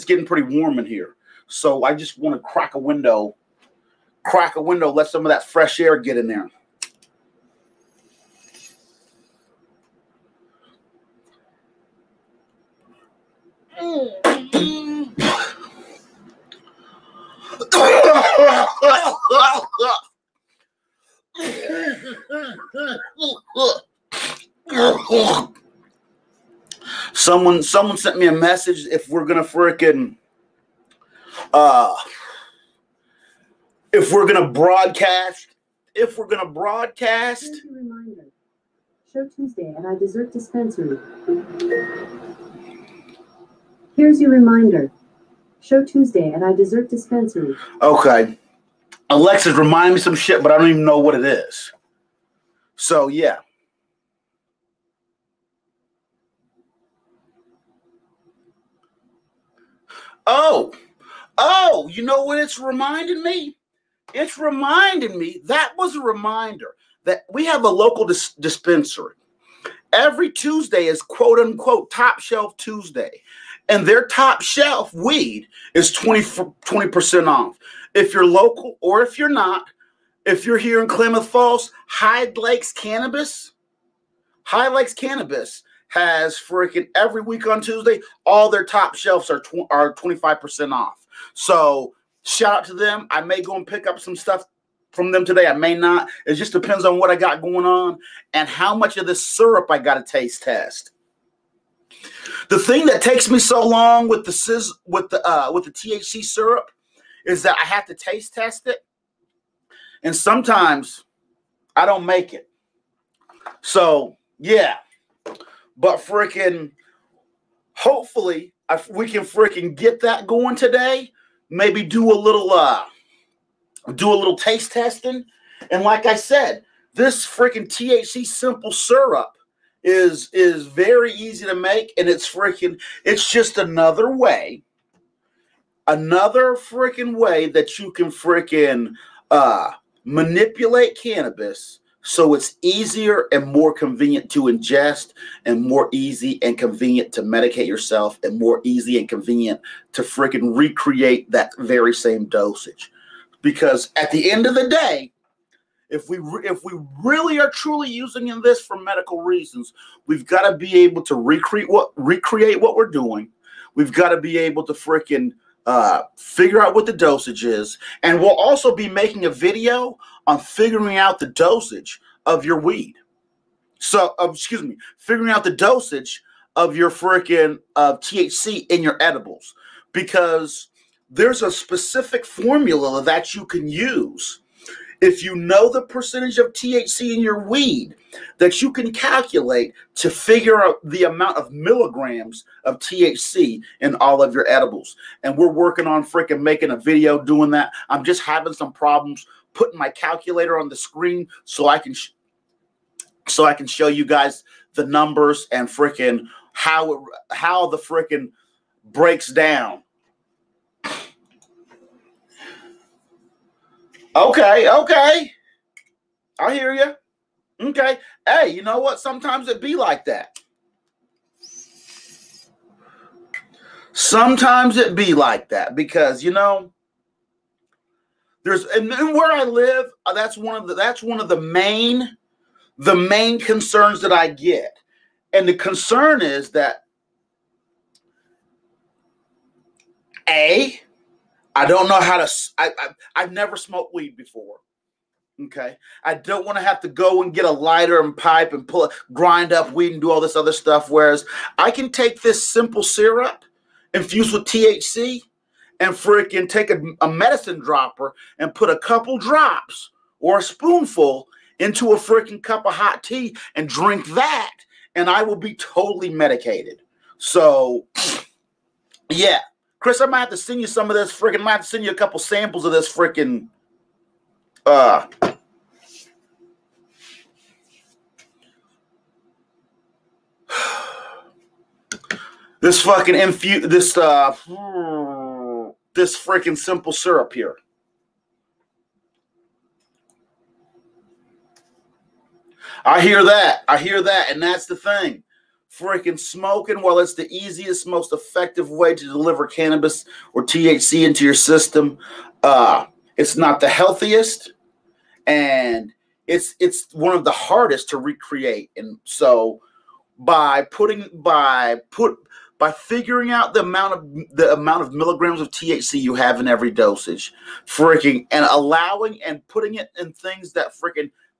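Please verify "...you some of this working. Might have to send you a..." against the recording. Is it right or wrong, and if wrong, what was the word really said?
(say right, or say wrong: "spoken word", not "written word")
wrong: "freaking", not "working".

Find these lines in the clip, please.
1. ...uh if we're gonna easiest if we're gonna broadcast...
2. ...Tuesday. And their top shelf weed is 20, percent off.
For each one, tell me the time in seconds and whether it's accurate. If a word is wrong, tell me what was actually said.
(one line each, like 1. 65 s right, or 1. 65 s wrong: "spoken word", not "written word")
1. 31 s wrong: "broadcast", not "easiest"
2. 72 s right.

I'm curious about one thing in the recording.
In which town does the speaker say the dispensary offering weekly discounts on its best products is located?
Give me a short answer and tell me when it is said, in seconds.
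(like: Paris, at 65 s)
Klamath Falls, at 80 s.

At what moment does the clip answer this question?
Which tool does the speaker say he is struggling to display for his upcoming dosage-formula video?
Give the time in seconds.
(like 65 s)
199 s.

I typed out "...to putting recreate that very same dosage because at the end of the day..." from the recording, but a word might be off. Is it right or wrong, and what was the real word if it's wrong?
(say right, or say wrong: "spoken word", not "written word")
wrong: "freaking", not "putting".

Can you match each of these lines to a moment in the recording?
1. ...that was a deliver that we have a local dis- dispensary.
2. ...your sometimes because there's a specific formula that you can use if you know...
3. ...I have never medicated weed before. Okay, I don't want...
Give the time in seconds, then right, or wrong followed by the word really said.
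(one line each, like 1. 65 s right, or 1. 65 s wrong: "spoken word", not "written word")
1. 65 s wrong: "reminder", not "deliver"
2. 178 s wrong: "edibles", not "sometimes"
3. 243 s wrong: "smoked", not "medicated".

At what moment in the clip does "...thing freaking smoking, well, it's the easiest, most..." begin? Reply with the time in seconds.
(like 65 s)
294 s.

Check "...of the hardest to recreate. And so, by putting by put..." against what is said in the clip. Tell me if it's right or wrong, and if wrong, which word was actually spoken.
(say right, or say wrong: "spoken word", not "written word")
right.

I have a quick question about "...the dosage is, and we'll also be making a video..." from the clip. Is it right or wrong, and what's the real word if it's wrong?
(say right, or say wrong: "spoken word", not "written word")
right.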